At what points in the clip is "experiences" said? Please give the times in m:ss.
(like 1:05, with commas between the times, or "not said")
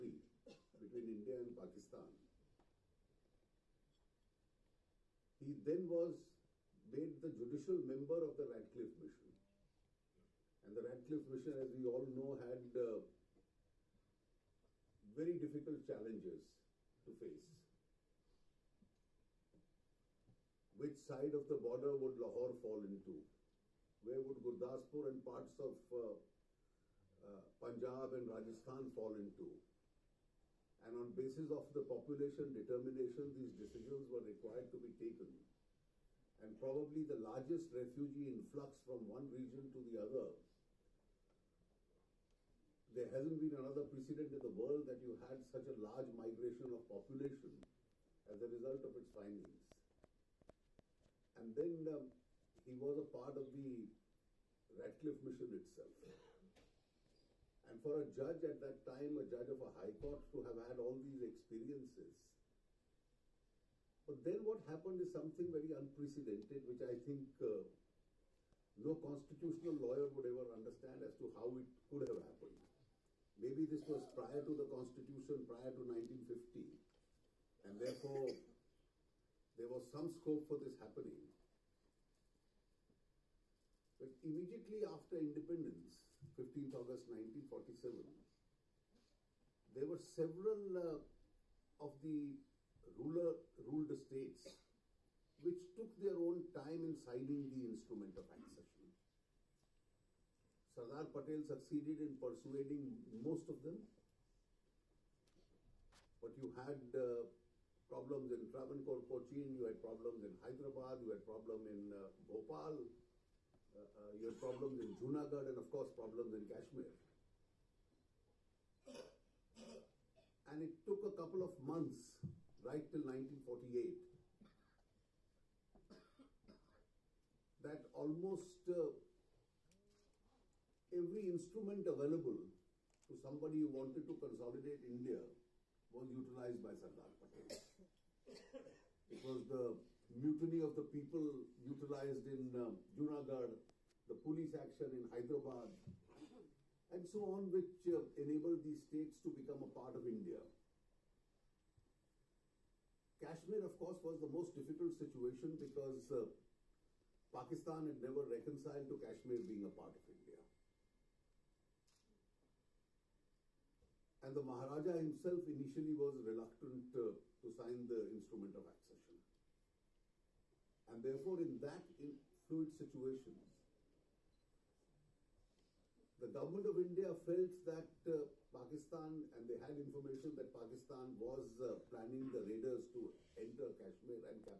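1:01.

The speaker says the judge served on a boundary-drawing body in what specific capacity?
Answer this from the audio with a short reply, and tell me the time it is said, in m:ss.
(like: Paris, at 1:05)
Judicial member, at 0:07.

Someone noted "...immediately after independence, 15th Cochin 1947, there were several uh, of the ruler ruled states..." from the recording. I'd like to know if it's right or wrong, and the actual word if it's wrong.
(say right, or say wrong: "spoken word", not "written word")
wrong: "August", not "Cochin".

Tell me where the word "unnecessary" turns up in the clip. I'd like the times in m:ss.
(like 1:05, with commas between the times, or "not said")
not said.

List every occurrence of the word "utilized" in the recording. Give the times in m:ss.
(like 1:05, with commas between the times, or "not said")
2:16, 2:21.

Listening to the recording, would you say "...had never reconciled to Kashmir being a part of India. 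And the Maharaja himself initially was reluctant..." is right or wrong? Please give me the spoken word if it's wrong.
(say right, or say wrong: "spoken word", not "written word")
right.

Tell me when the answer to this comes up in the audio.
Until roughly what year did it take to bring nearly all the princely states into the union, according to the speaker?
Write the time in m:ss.
2:03.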